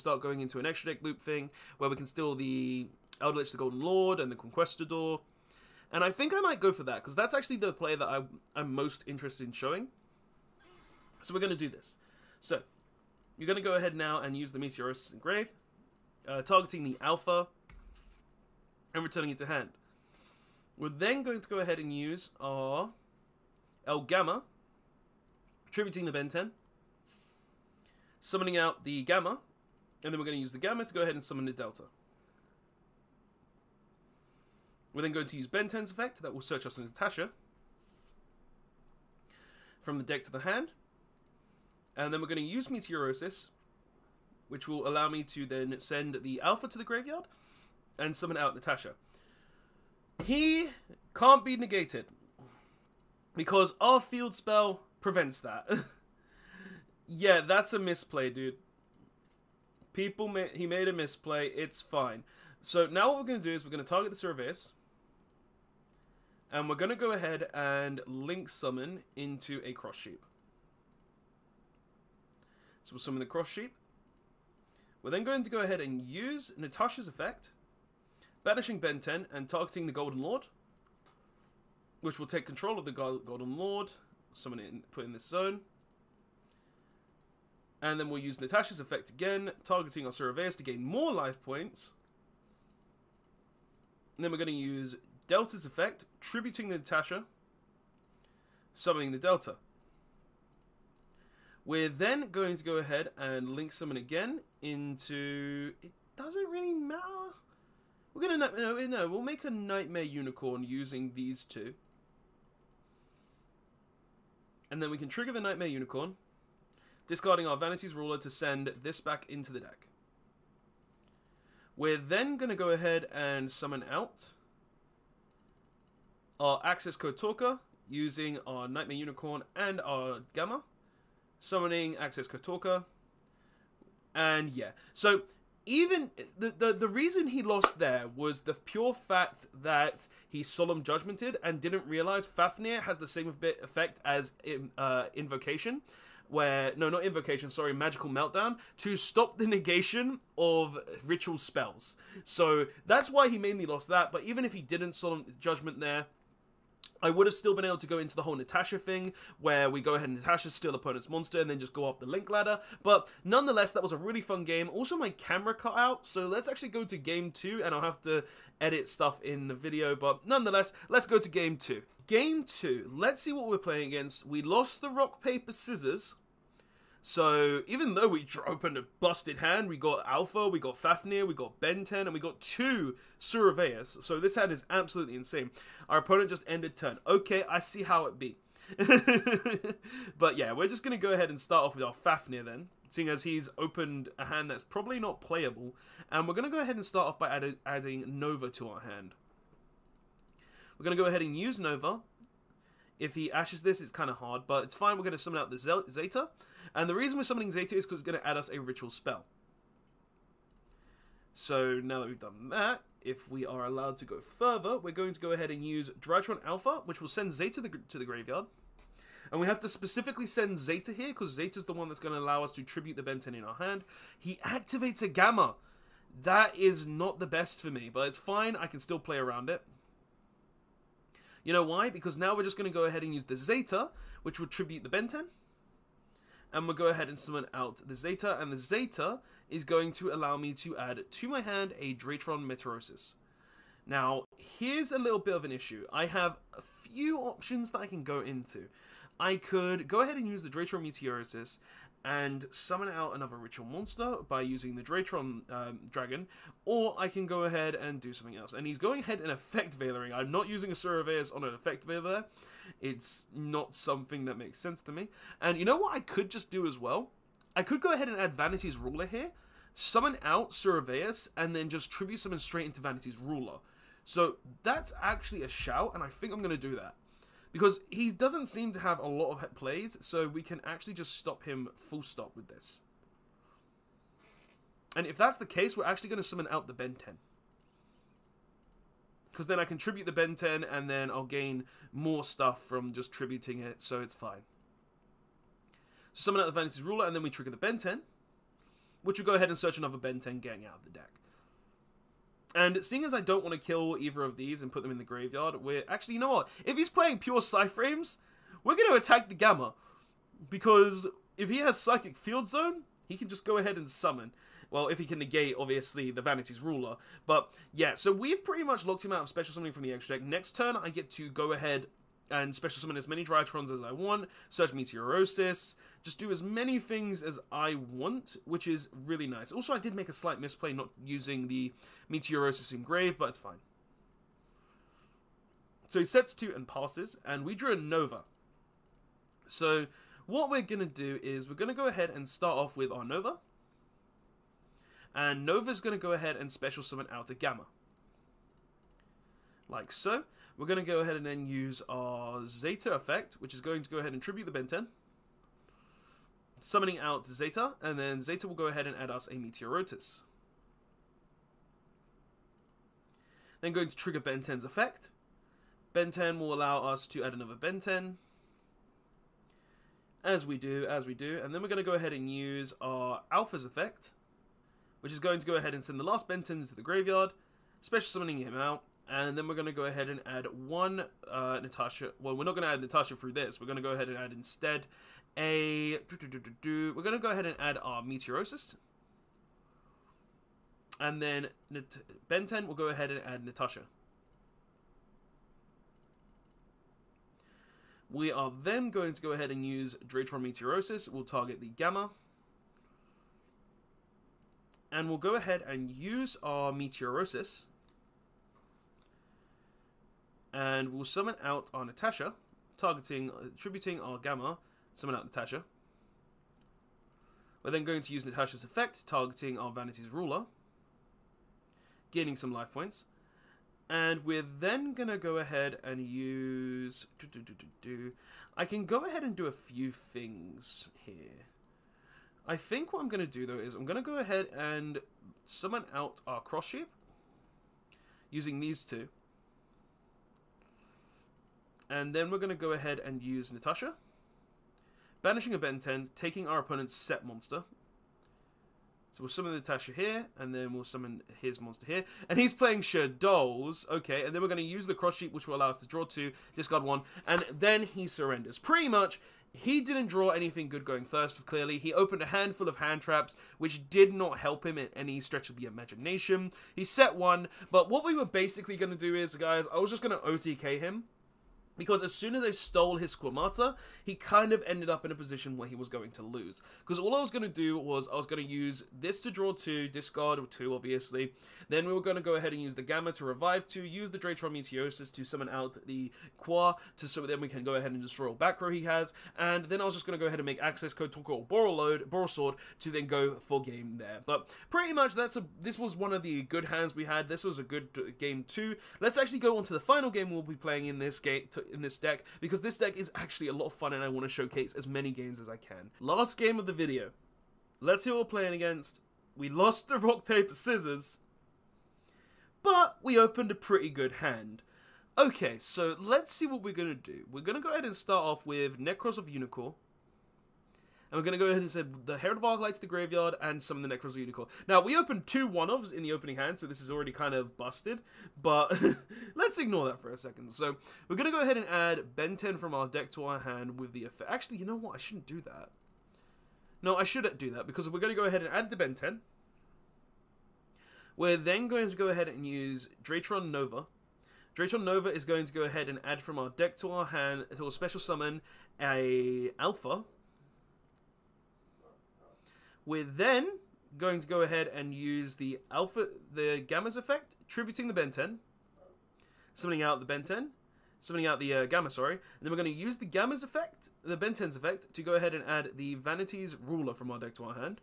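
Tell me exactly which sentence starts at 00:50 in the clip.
He can't be negated because our field spell prevents that.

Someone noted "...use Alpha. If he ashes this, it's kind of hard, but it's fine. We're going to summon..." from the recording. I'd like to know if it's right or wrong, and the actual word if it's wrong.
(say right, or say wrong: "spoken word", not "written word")
wrong: "Nova", not "Alpha".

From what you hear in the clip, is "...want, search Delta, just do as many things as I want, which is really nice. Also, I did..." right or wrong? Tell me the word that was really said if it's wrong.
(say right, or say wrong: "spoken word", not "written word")
wrong: "Meteorosis", not "Delta".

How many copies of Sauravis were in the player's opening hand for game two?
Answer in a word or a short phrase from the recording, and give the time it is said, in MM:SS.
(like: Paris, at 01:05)
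2, at 03:02.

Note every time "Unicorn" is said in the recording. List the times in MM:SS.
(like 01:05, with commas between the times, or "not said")
01:50, 01:55, 02:08, 08:39, 08:44.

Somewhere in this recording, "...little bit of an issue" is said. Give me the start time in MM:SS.
04:04.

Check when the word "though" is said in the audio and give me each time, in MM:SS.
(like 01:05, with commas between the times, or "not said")
02:57, 07:13.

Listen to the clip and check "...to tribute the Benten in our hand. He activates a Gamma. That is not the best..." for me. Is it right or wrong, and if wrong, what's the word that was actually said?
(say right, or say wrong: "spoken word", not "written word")
right.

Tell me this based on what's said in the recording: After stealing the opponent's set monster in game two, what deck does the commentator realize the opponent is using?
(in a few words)
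Shaddolls.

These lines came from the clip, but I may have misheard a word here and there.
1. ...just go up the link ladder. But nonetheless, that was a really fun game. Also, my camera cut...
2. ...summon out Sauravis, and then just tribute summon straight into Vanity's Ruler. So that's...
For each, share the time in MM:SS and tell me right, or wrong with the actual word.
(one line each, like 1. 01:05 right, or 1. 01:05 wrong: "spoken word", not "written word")
1. 02:41 right
2. 04:29 right.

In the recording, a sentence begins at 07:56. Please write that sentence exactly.
Because all I was going to do was I was going to use this to draw two, discard two, obviously.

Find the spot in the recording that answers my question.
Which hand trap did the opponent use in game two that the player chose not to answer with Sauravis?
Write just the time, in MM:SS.
04:19.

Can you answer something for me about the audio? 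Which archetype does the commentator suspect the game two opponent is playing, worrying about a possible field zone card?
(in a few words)
Psyframes.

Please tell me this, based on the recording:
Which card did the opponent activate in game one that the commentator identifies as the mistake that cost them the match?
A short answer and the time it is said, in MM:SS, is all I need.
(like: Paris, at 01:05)
Solemn Judgment, at 02:20.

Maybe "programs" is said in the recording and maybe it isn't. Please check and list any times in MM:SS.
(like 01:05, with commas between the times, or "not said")
not said.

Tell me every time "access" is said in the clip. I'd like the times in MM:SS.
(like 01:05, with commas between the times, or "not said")
02:06, 02:11, 08:10.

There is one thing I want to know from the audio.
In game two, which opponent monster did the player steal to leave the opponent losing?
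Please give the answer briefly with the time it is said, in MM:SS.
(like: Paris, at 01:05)
Squamata, at 07:53.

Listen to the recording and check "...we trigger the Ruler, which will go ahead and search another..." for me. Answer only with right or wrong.
wrong.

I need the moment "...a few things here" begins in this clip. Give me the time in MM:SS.
07:09.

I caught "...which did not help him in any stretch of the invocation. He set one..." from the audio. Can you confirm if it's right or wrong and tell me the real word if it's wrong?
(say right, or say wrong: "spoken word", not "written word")
wrong: "imagination", not "invocation".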